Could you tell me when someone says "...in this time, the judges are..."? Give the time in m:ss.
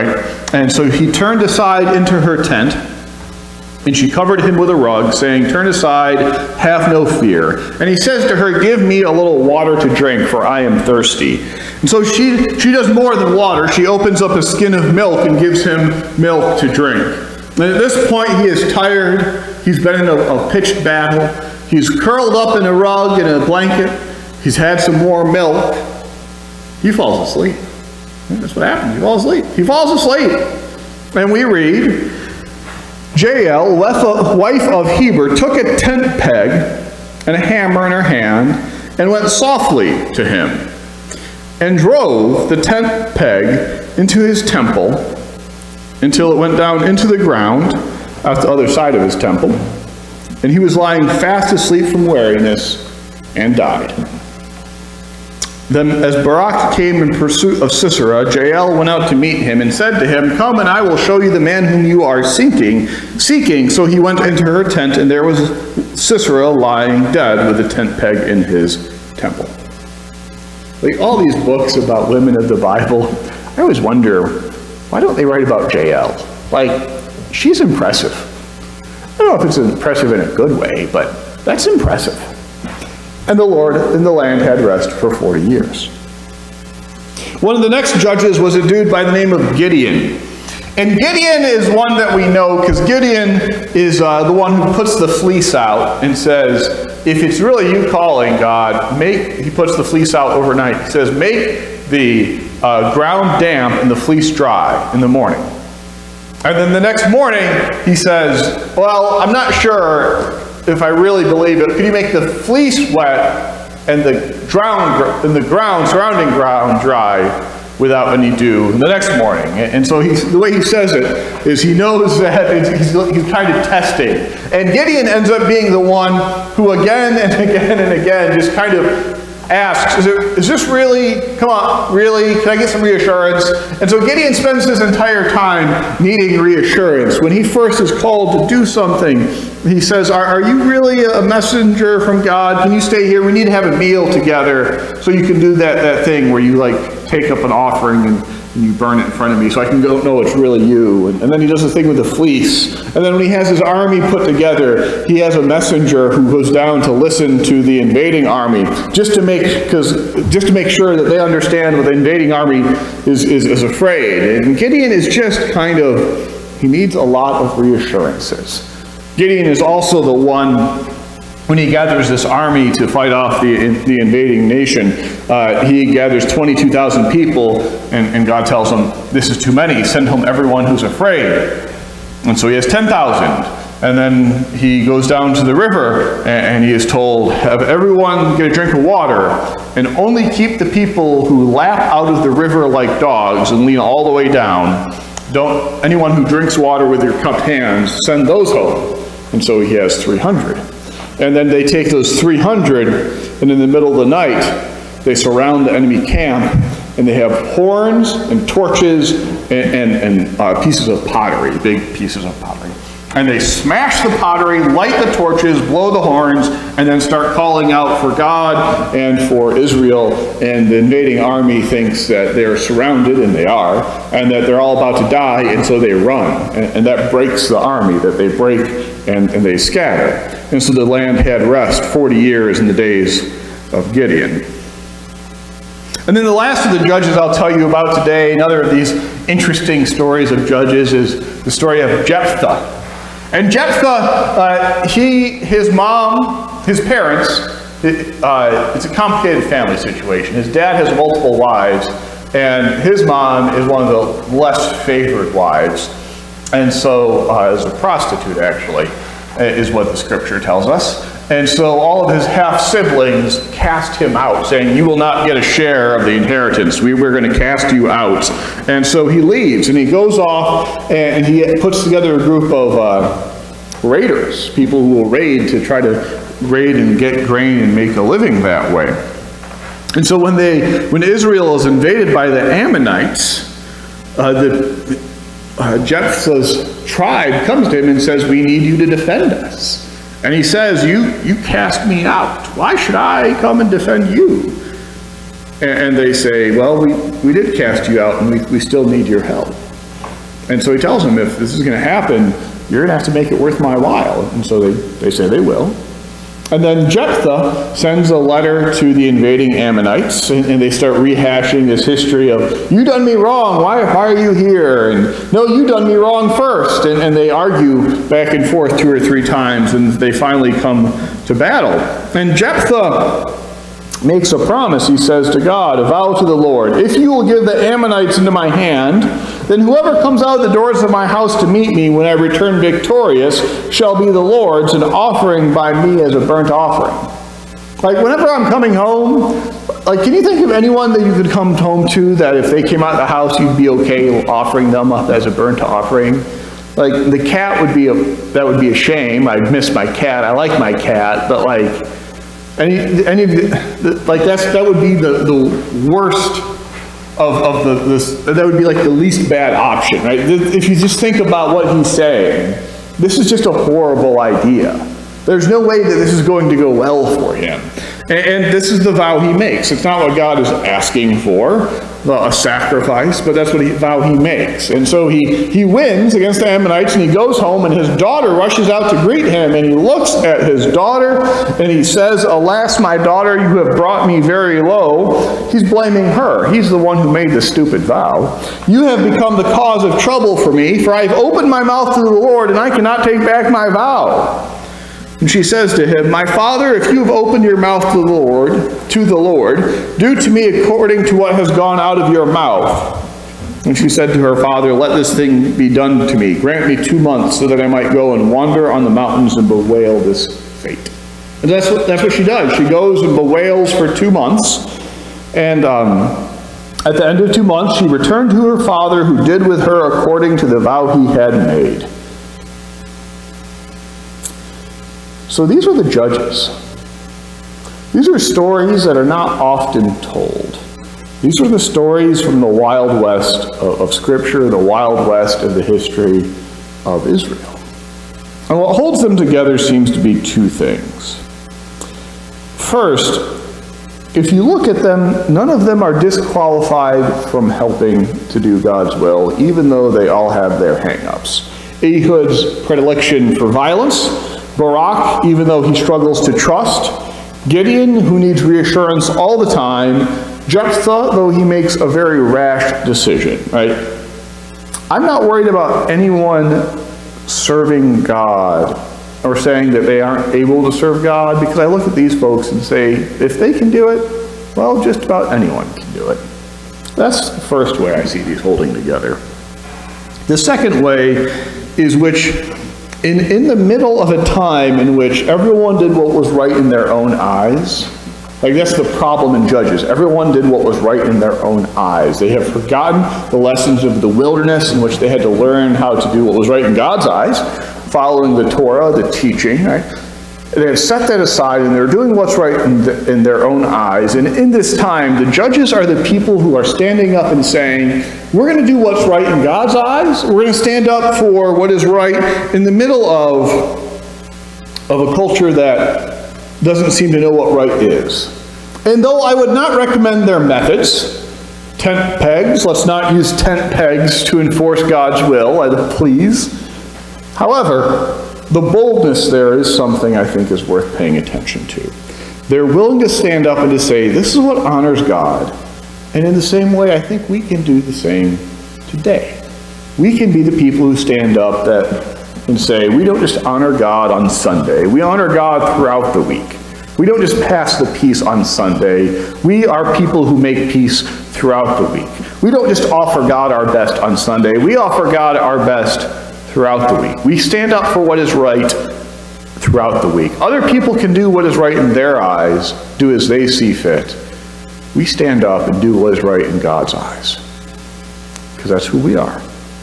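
8:24.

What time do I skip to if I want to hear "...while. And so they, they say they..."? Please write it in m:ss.
5:03.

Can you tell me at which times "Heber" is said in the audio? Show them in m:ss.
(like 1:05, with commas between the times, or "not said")
0:34.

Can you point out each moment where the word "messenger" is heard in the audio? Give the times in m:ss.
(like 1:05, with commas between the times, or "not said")
2:21, 2:35.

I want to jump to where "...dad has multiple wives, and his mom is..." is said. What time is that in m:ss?
4:10.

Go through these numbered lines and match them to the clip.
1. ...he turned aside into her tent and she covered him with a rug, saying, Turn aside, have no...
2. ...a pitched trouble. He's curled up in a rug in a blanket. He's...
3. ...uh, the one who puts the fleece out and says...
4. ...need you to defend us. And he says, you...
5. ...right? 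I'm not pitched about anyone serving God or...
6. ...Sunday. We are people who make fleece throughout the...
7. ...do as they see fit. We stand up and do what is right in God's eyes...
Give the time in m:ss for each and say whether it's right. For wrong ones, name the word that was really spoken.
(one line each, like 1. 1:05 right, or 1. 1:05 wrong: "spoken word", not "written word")
1. 0:00 right
2. 0:20 wrong: "battle", not "trouble"
3. 1:34 right
4. 4:48 right
5. 7:43 wrong: "worried", not "pitched"
6. 9:08 wrong: "peace", not "fleece"
7. 9:22 right.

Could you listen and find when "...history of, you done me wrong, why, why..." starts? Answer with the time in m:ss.
5:11.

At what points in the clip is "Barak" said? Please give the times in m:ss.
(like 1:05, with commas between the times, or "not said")
0:56, 7:34.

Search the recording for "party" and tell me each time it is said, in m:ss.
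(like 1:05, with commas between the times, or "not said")
not said.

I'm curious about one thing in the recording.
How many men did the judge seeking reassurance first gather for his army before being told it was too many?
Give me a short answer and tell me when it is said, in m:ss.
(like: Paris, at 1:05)
22,000, at 2:56.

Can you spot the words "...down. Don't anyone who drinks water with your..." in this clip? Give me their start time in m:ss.
3:14.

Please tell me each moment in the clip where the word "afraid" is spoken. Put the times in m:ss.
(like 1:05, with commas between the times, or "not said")
2:43, 3:00.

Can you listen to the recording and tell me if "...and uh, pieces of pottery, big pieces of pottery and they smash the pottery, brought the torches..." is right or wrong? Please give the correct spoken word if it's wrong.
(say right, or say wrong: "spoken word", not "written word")
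wrong: "light", not "brought".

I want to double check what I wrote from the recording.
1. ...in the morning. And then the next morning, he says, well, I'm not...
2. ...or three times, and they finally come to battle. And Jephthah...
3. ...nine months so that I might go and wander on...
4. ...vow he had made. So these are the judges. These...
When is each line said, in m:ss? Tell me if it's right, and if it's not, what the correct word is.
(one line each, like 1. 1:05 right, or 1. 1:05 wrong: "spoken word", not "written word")
1. 1:44 right
2. 5:18 right
3. 6:46 wrong: "two", not "nine"
4. 7:00 right.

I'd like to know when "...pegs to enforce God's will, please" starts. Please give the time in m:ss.
8:43.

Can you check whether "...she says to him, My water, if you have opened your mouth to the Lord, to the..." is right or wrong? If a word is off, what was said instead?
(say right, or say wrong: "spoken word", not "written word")
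wrong: "father", not "water".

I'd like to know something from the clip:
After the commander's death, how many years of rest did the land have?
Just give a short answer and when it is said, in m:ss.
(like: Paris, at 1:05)
40, at 1:24.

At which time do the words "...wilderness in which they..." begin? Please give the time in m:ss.
8:14.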